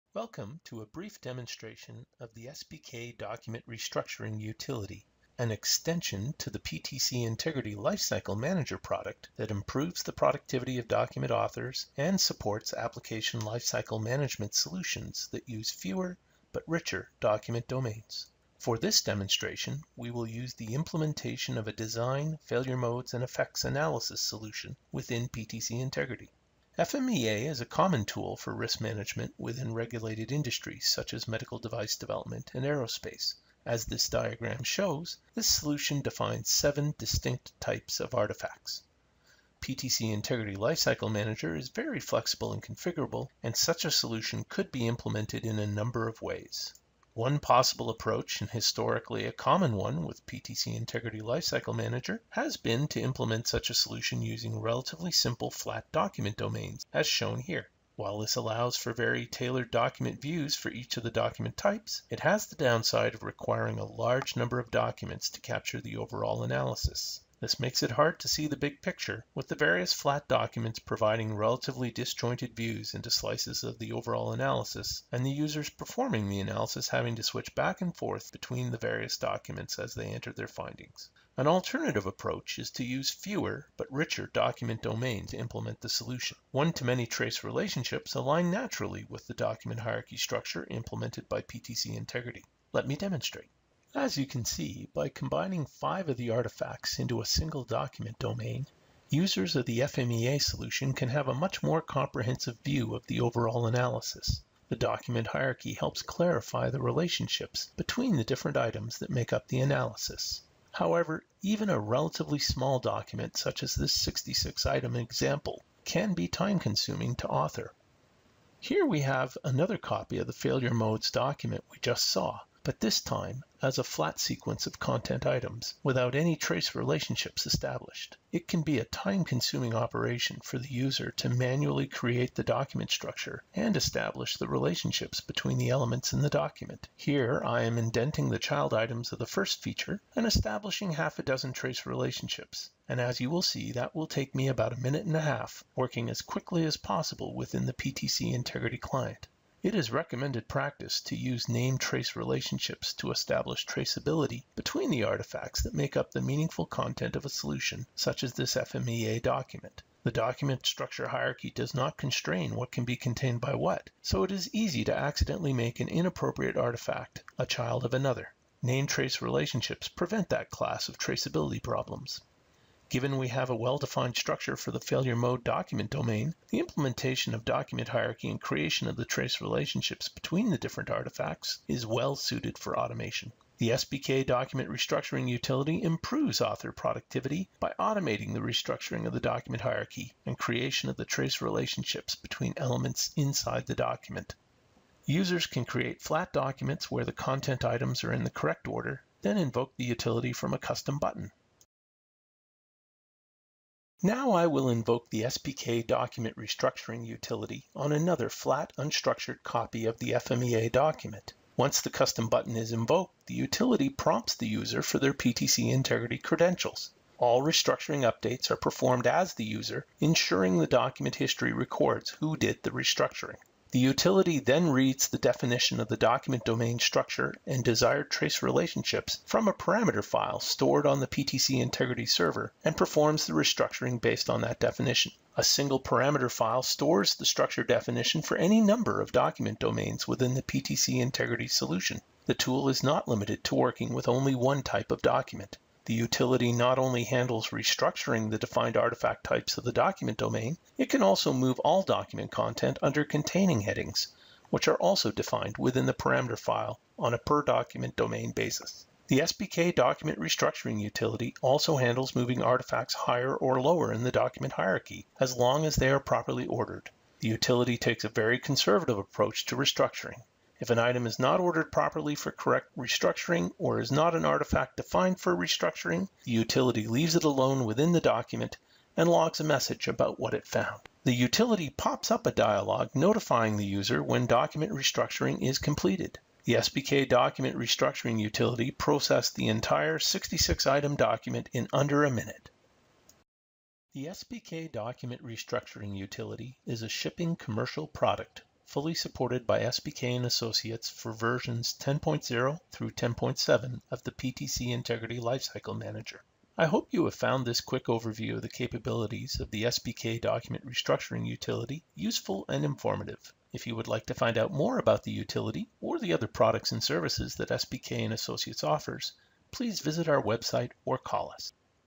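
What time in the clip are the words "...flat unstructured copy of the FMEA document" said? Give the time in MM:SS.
03:28.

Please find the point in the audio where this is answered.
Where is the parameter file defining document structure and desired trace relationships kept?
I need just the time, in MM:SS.
03:51.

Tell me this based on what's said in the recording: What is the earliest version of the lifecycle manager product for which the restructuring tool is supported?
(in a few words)
10.0.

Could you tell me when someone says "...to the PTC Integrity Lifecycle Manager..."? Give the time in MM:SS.
00:06.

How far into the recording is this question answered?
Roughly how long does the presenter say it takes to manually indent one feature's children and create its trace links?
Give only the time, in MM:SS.
02:24.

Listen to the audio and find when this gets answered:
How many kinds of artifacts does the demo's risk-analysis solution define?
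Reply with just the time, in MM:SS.
00:36.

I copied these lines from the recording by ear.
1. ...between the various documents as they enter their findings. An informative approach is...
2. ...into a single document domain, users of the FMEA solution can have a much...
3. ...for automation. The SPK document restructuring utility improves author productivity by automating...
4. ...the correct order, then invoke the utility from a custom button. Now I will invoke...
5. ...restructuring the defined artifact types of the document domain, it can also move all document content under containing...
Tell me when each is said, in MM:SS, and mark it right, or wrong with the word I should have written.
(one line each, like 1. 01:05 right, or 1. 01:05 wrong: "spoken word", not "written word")
1. 01:18 wrong: "alternative", not "informative"
2. 01:36 right
3. 03:02 right
4. 03:18 right
5. 04:07 right.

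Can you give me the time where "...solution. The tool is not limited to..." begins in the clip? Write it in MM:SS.
04:01.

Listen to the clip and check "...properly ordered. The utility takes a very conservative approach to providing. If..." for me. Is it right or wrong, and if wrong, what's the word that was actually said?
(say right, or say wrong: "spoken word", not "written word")
wrong: "restructuring", not "providing".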